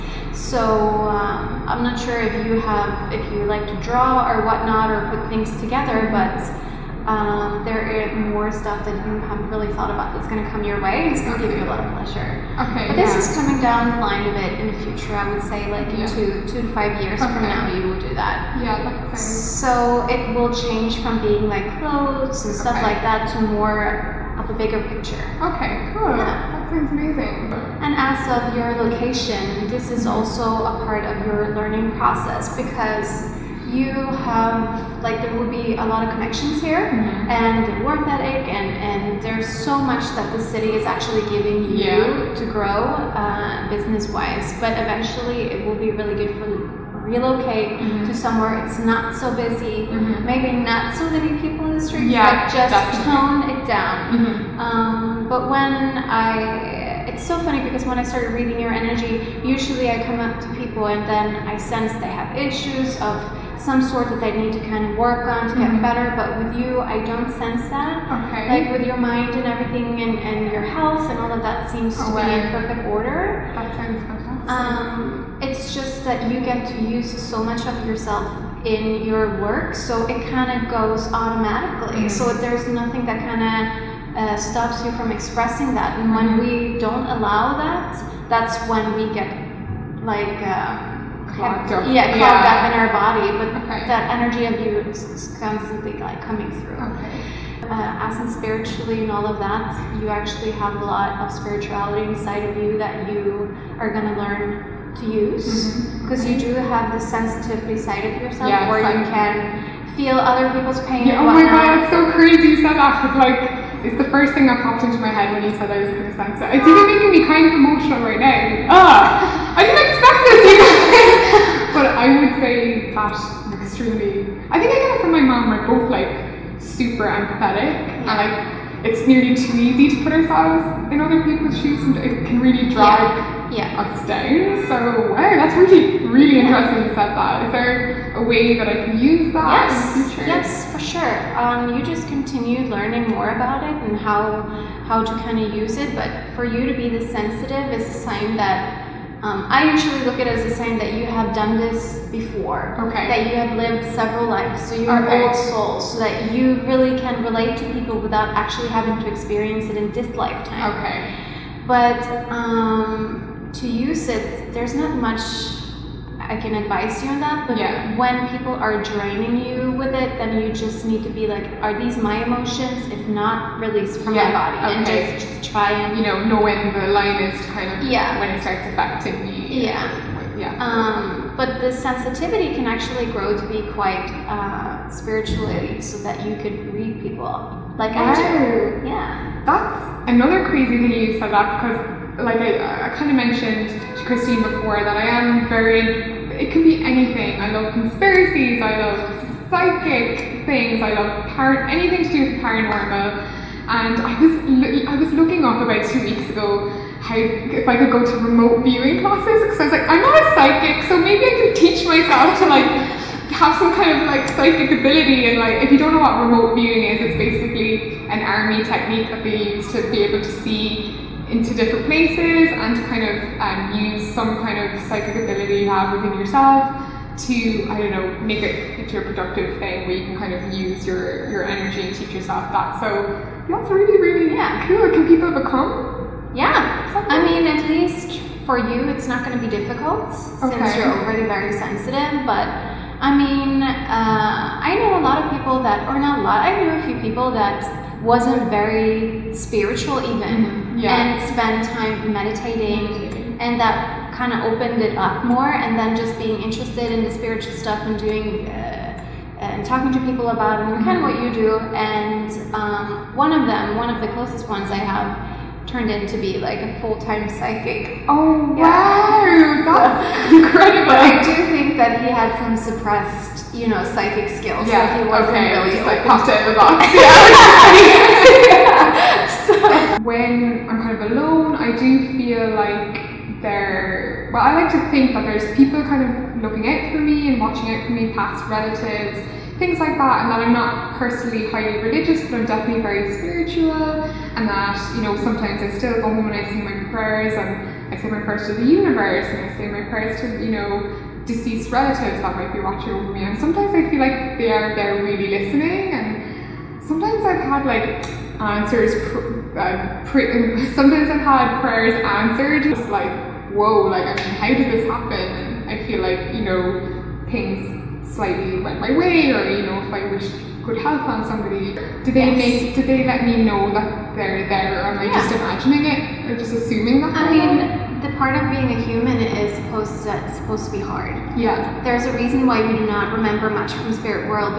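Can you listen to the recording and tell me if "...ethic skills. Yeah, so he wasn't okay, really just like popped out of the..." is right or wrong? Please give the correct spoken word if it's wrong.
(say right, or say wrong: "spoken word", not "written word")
wrong: "psychic", not "ethic".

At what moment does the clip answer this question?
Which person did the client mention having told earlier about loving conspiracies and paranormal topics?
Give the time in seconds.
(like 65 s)
194 s.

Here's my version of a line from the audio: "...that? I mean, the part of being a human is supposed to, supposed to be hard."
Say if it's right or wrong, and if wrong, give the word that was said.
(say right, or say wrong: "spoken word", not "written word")
right.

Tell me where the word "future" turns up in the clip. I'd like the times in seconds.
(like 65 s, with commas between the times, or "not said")
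14 s, 140 s.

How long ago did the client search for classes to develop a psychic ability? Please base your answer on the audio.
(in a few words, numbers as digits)
about two weeks ago.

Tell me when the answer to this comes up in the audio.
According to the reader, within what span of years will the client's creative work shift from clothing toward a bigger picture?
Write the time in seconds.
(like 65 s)
16 s.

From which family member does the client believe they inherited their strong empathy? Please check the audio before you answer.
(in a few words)
mom.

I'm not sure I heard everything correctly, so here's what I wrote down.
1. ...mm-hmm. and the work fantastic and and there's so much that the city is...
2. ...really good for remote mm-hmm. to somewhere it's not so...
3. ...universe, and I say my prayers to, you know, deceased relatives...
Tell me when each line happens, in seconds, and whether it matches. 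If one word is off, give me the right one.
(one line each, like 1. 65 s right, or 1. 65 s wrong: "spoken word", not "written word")
1. 36 s wrong: "ethic", not "fantastic"
2. 45 s wrong: "relocate", not "remote"
3. 298 s right.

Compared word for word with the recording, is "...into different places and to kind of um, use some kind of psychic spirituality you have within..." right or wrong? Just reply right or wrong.
wrong.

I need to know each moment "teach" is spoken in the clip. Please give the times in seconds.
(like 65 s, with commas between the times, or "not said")
211 s, 231 s.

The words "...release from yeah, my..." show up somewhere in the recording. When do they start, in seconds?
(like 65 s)
173 s.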